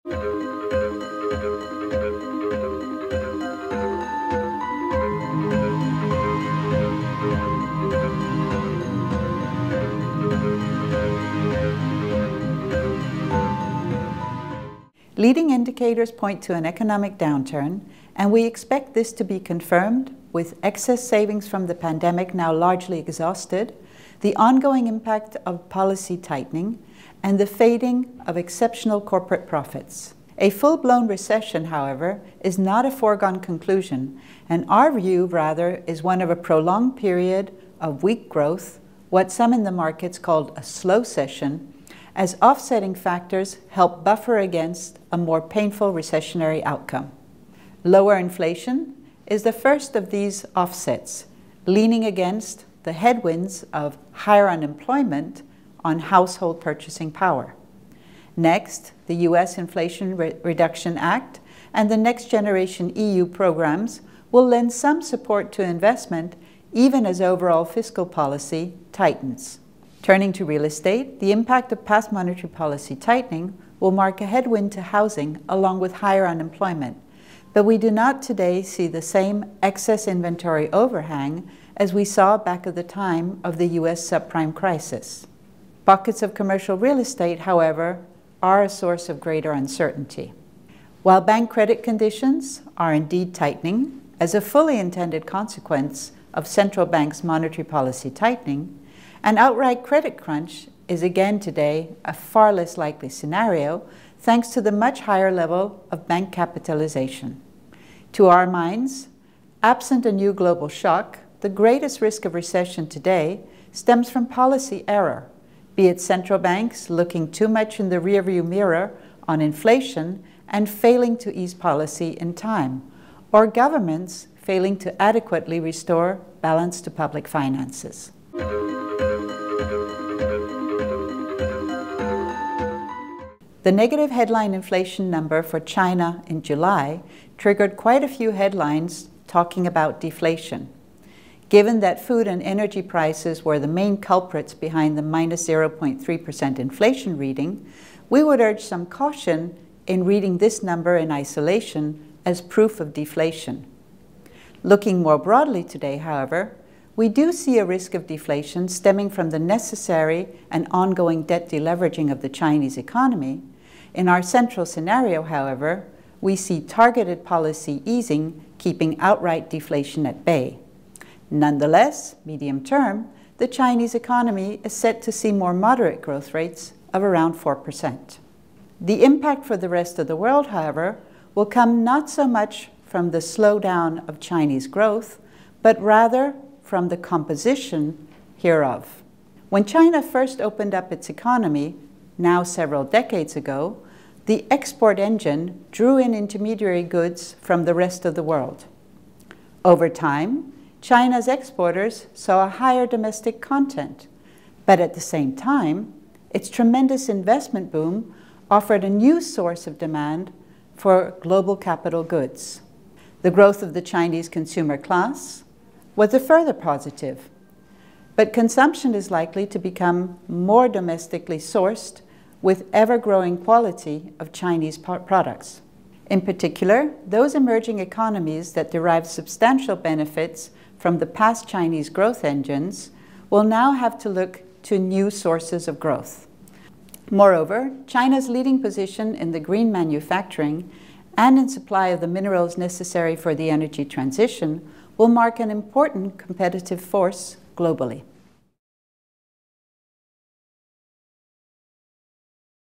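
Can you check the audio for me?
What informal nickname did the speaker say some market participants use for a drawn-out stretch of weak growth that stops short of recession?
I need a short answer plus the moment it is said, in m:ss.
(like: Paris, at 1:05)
slowcession, at 0:40.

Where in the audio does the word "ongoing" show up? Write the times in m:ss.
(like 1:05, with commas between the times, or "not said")
0:24, 2:40.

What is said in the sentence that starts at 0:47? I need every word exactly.
Lower inflation is the first of these offsets, leaning against the headwinds of higher unemployment on household purchasing power.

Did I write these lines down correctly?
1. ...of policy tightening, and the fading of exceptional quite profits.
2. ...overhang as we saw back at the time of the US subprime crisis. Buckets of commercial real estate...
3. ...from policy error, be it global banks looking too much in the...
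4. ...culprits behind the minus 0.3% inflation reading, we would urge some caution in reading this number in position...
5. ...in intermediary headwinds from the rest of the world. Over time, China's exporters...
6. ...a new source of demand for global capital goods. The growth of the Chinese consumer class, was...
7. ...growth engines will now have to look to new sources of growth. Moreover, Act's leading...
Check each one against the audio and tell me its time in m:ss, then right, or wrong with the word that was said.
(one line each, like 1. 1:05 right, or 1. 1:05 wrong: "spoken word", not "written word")
1. 0:25 wrong: "corporate", not "quite"
2. 1:20 right
3. 1:54 wrong: "central", not "global"
4. 2:23 wrong: "isolation", not "position"
5. 3:15 wrong: "goods", not "headwinds"
6. 3:28 right
7. 3:51 wrong: "China", not "Act".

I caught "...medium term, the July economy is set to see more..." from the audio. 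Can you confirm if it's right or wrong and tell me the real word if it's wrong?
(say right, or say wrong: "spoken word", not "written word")
wrong: "Chinese", not "July".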